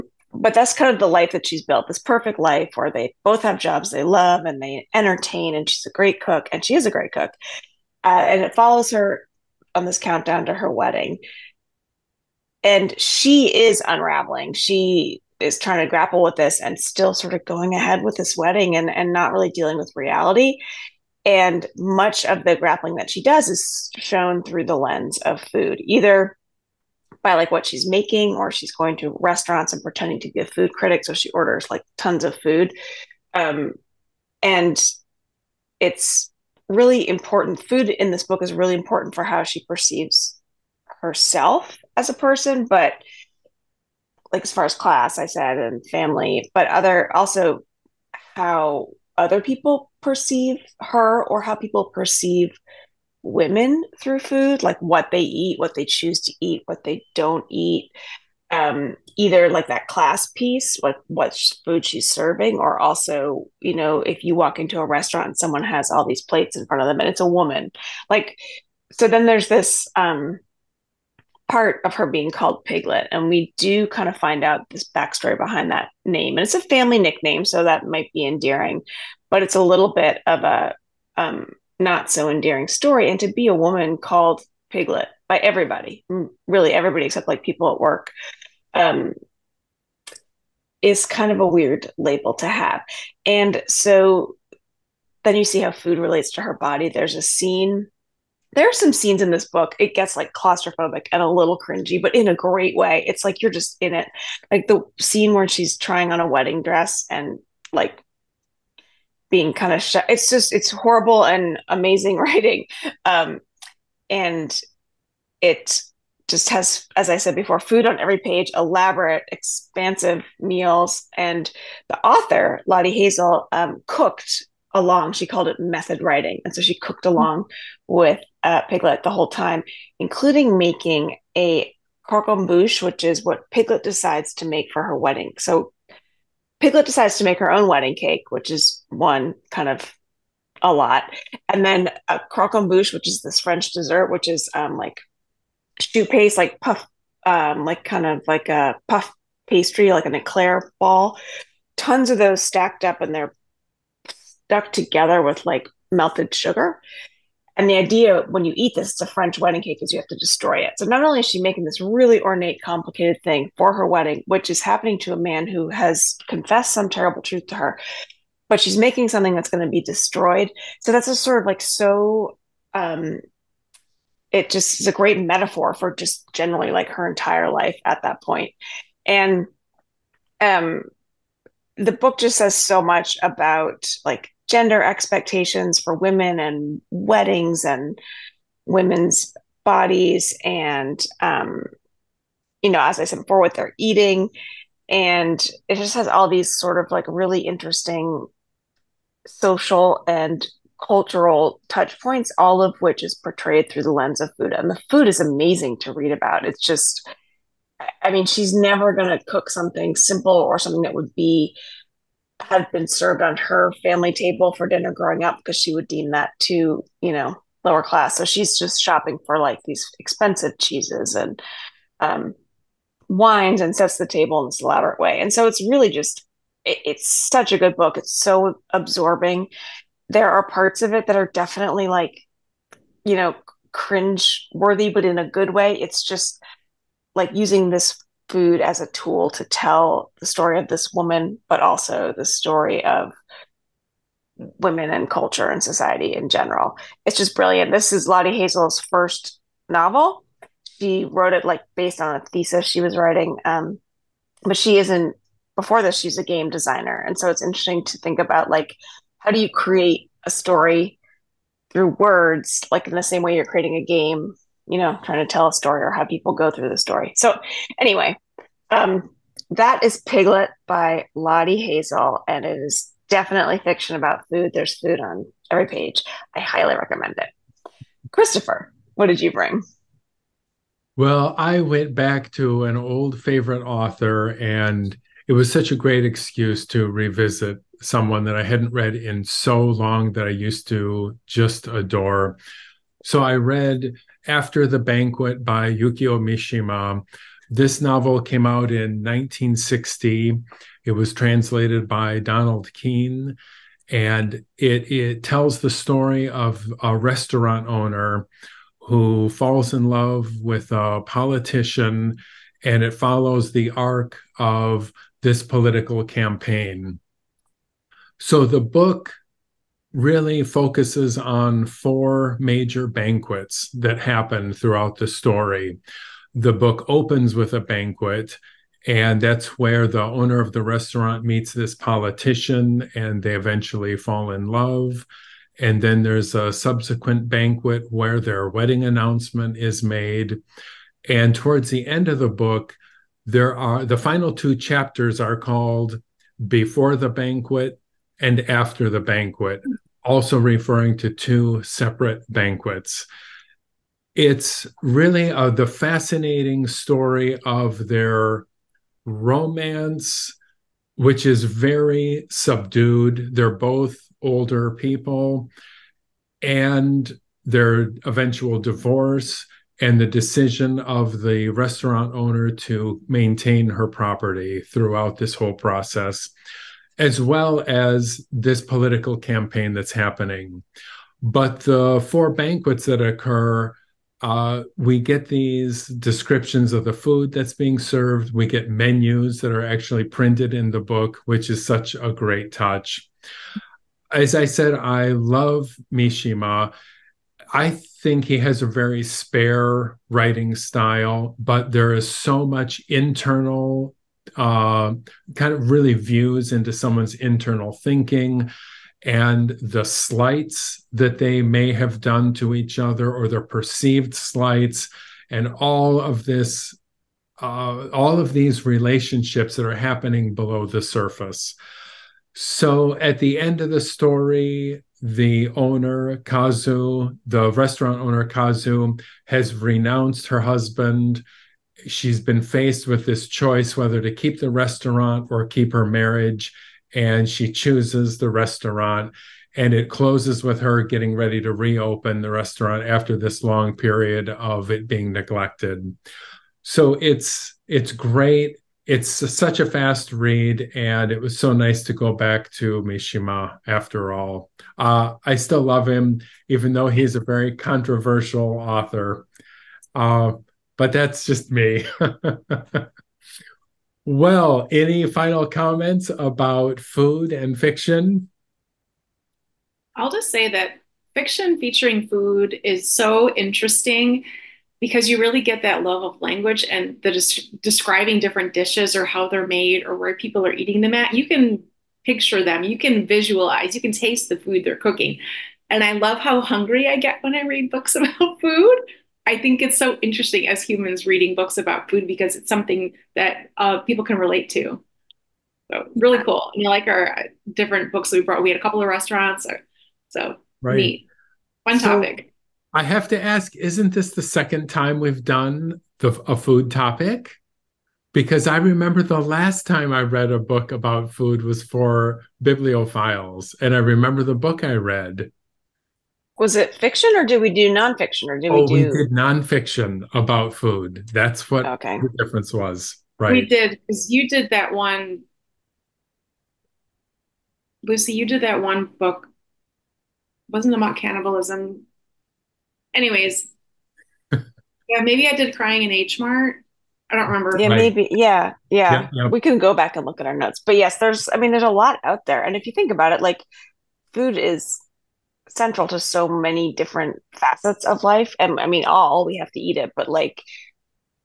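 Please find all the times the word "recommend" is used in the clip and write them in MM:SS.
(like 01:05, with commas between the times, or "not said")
04:36.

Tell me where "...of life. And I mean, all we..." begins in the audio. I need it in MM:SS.
09:07.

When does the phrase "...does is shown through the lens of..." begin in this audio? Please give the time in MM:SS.
00:23.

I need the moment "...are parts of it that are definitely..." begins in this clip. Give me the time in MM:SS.
03:50.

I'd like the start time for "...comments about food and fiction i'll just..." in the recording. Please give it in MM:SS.
07:45.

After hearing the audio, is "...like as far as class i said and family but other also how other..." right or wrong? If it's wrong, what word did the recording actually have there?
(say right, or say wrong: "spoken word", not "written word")
right.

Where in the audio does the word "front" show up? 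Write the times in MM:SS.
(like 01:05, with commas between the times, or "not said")
01:06.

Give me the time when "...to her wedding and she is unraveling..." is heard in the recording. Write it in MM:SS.
00:10.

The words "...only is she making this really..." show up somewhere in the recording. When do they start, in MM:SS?
02:41.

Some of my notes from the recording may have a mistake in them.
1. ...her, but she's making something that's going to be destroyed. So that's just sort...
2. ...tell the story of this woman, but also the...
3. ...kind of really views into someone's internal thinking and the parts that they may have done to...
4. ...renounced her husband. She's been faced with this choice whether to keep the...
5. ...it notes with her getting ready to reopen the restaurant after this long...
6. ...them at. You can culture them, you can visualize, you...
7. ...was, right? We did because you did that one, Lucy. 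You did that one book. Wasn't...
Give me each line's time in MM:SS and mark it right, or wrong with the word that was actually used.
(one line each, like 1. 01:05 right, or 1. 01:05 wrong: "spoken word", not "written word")
1. 02:47 right
2. 03:59 right
3. 06:45 wrong: "slights", not "parts"
4. 07:09 right
5. 07:19 wrong: "closes", not "notes"
6. 08:00 wrong: "picture", not "culture"
7. 08:42 right.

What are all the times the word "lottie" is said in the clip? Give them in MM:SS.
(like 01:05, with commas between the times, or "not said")
02:02, 04:08, 04:31.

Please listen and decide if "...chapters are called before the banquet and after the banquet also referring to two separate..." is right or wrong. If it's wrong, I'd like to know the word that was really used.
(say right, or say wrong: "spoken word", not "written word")
right.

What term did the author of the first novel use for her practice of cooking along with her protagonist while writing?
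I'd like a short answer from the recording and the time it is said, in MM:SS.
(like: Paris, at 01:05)
method writing, at 02:05.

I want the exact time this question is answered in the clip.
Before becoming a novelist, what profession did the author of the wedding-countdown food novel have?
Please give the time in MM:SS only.
04:16.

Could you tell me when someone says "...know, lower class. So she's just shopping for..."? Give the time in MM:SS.
03:37.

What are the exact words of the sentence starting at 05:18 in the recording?
So the book really focuses on four major banquets that happen throughout the story.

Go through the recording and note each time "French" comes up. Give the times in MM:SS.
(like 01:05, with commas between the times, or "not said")
02:23, 02:39.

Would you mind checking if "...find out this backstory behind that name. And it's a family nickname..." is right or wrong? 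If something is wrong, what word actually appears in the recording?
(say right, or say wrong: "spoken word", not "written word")
right.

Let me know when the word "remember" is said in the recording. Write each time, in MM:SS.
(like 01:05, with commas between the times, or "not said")
08:28, 08:33, 08:57.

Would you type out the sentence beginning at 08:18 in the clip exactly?
We had a couple of restaurants.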